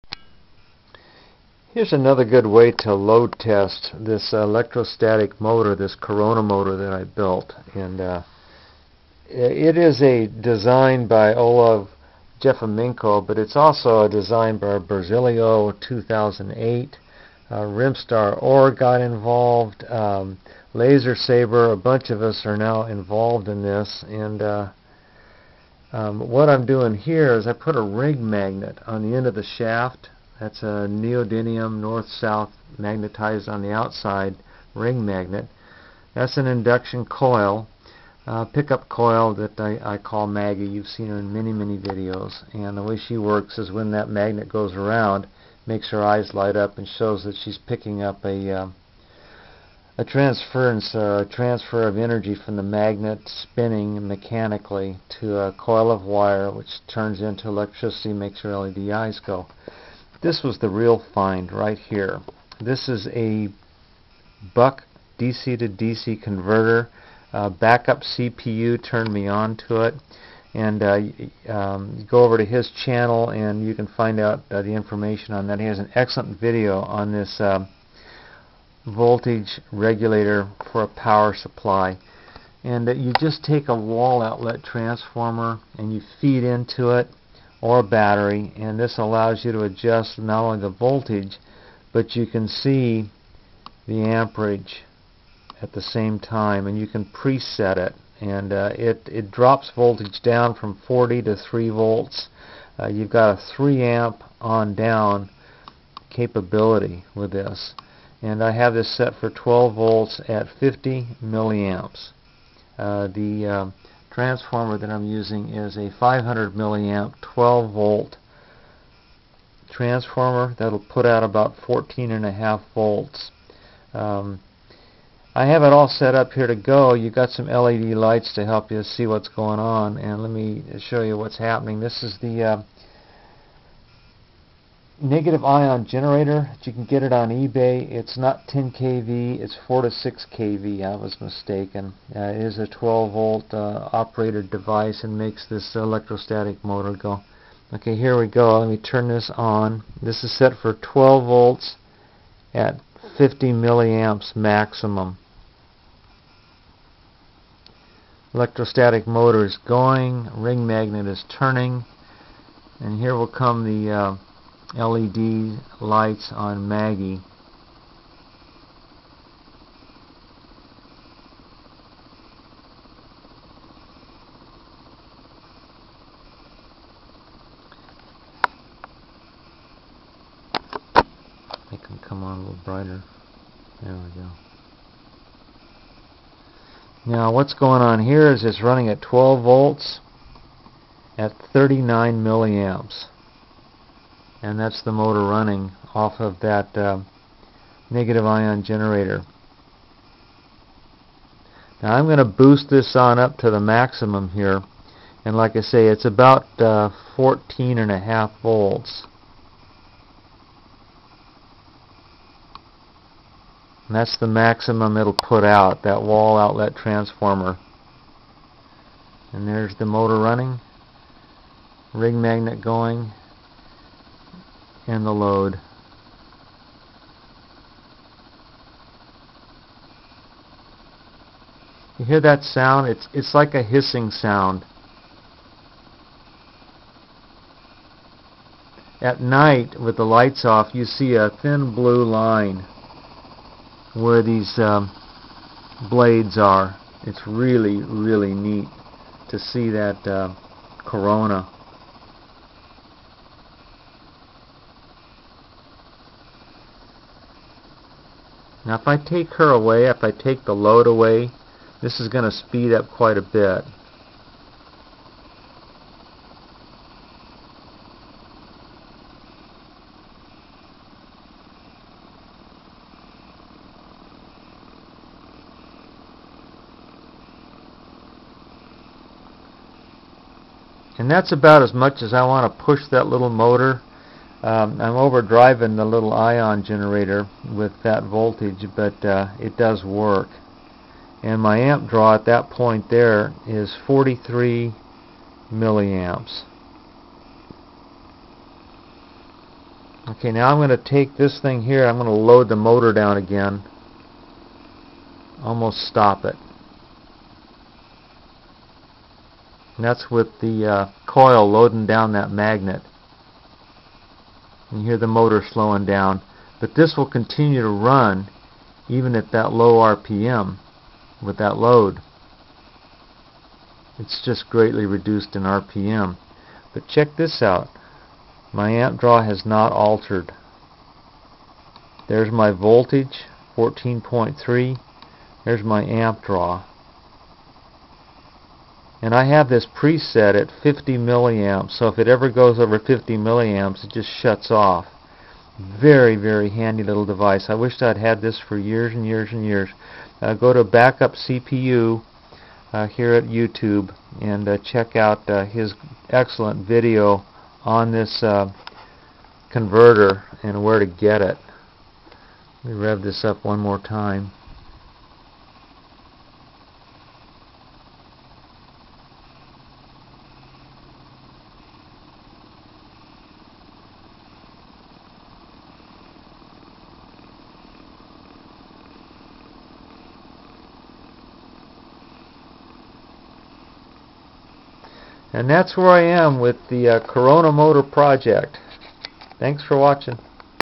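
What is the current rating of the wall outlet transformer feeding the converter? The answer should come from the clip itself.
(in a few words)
500 milliamps.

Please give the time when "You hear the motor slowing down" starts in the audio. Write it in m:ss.
5:14.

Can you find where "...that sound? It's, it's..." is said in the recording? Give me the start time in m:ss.
3:52.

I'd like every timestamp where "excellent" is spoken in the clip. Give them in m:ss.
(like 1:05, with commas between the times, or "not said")
1:15, 5:56.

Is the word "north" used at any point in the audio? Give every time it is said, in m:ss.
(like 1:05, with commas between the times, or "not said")
0:31.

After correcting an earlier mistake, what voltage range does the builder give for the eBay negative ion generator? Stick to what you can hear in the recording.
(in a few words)
4 to 6 kV.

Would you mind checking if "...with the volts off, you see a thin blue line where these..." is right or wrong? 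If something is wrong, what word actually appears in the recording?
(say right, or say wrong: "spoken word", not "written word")
wrong: "lights", not "volts".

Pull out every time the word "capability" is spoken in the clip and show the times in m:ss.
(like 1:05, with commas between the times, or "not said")
1:46.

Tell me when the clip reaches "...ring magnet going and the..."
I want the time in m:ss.
3:41.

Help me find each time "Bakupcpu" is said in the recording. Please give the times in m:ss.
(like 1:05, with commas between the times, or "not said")
1:07, 5:50.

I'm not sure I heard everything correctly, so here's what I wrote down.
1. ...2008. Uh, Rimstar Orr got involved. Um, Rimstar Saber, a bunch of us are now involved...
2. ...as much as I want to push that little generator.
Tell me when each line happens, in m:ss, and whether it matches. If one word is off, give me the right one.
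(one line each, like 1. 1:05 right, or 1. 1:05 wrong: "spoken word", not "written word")
1. 0:15 wrong: "Laser", not "Rimstar"
2. 4:41 wrong: "motor", not "generator".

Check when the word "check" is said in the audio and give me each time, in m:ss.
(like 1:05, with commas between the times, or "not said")
5:26, 5:54.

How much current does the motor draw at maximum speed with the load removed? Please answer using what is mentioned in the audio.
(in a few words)
43 milliamps.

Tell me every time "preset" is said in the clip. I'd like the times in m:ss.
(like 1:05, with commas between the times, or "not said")
1:37, 5:39.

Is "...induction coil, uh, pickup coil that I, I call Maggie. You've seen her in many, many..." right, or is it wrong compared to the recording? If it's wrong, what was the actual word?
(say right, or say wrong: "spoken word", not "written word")
right.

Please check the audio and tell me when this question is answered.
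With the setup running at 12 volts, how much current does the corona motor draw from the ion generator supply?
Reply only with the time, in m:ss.
3:11.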